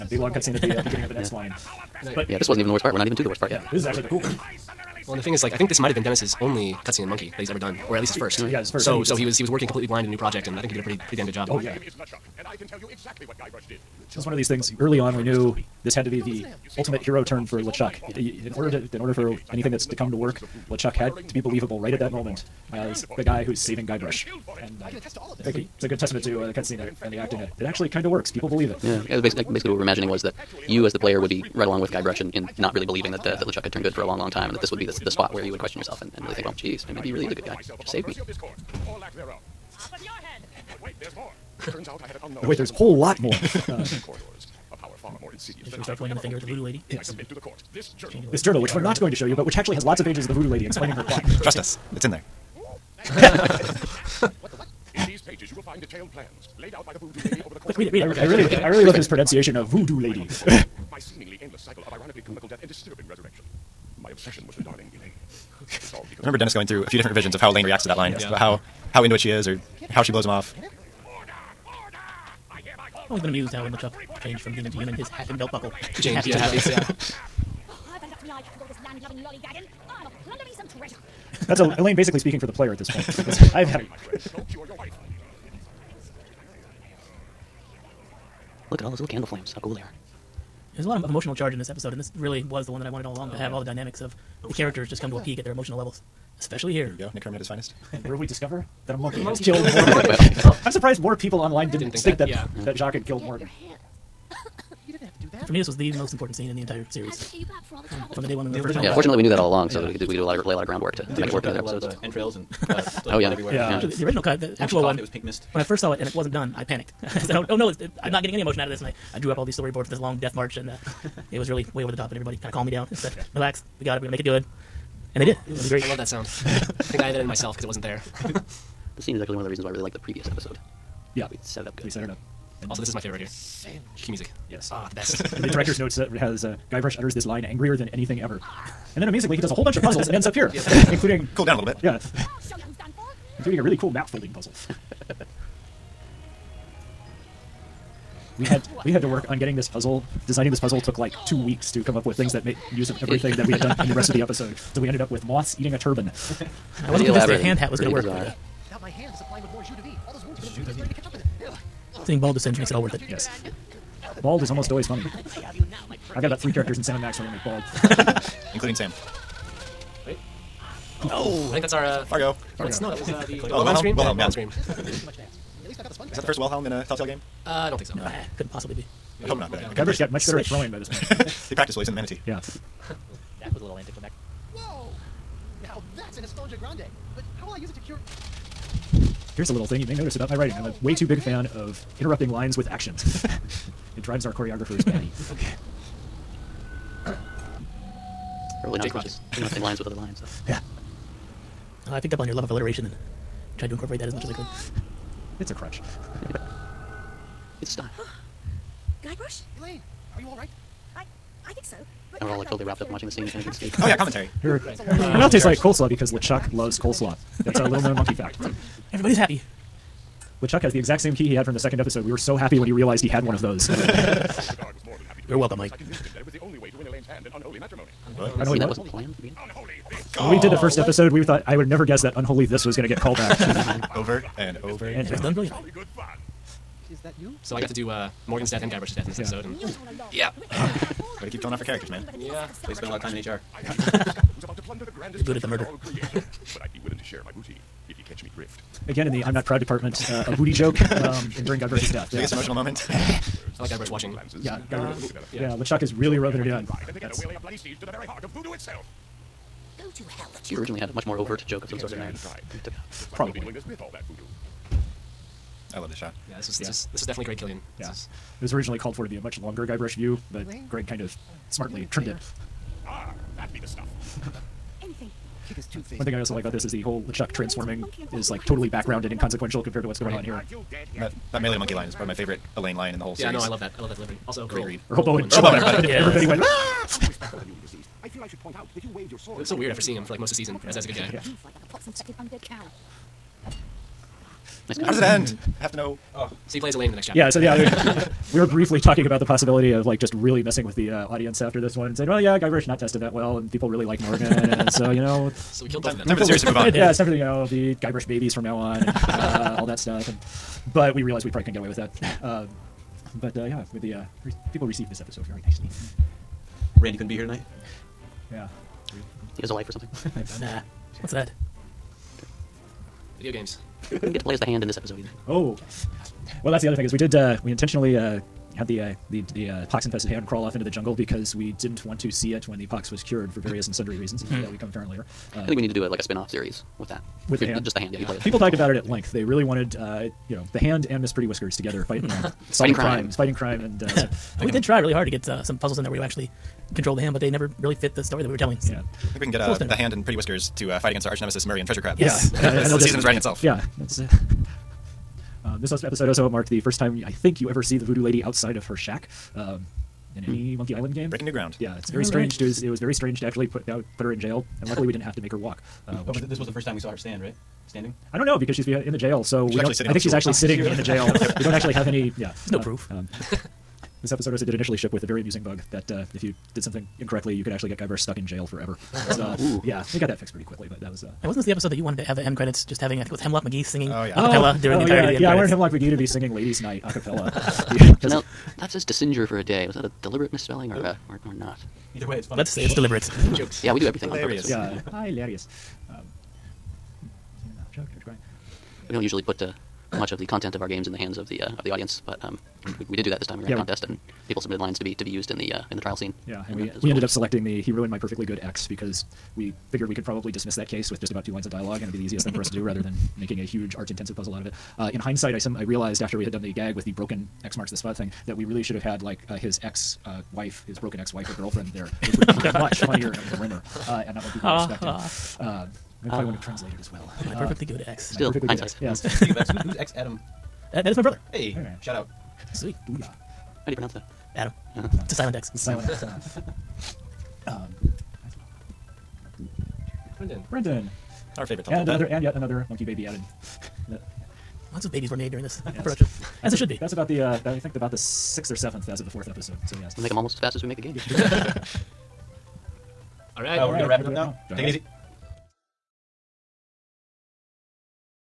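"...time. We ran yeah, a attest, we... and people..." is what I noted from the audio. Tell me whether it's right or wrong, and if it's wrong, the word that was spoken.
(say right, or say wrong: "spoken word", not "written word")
wrong: "contest", not "attest".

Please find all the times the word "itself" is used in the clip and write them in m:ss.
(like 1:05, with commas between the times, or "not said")
4:18, 5:53.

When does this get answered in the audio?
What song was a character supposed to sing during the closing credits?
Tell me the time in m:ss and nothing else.
6:26.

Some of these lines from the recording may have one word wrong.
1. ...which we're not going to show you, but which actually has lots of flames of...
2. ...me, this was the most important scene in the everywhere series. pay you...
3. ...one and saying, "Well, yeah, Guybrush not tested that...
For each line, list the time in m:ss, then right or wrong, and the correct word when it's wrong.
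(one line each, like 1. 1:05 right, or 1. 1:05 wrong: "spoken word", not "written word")
1. 0:48 wrong: "pages", not "flames"
2. 1:45 wrong: "entire", not "everywhere"
3. 5:01 right.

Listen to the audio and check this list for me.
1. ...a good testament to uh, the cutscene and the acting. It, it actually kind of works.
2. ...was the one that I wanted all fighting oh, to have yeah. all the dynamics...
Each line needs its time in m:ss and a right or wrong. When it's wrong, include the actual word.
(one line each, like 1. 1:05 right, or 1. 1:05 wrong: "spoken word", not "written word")
1. 0:25 right
2. 1:32 wrong: "along", not "fighting".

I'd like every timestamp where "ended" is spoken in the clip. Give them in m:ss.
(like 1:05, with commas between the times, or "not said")
2:34, 6:46.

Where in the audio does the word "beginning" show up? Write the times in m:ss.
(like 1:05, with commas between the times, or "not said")
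0:00, 3:49.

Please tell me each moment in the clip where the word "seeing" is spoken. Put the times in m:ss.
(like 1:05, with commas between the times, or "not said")
2:42, 4:49.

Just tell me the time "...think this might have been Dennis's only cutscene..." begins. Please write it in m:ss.
0:05.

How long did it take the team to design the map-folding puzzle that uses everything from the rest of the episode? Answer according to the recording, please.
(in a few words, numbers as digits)
2 weeks.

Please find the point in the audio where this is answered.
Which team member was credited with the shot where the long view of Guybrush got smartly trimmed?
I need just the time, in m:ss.
4:27.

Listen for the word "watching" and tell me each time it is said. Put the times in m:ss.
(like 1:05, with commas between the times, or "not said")
3:32, 4:13.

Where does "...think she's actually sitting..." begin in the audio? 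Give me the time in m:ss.
6:09.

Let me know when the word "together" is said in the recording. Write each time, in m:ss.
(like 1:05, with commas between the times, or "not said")
4:16, 5:41.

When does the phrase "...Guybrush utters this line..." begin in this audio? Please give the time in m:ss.
2:16.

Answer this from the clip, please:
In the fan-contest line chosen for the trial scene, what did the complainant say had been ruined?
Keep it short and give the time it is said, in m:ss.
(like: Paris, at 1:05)
My Perfectly Good Ex, at 6:47.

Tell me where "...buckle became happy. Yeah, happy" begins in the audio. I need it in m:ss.
1:15.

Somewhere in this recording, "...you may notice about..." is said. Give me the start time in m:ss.
3:09.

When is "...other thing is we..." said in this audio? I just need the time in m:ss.
5:26.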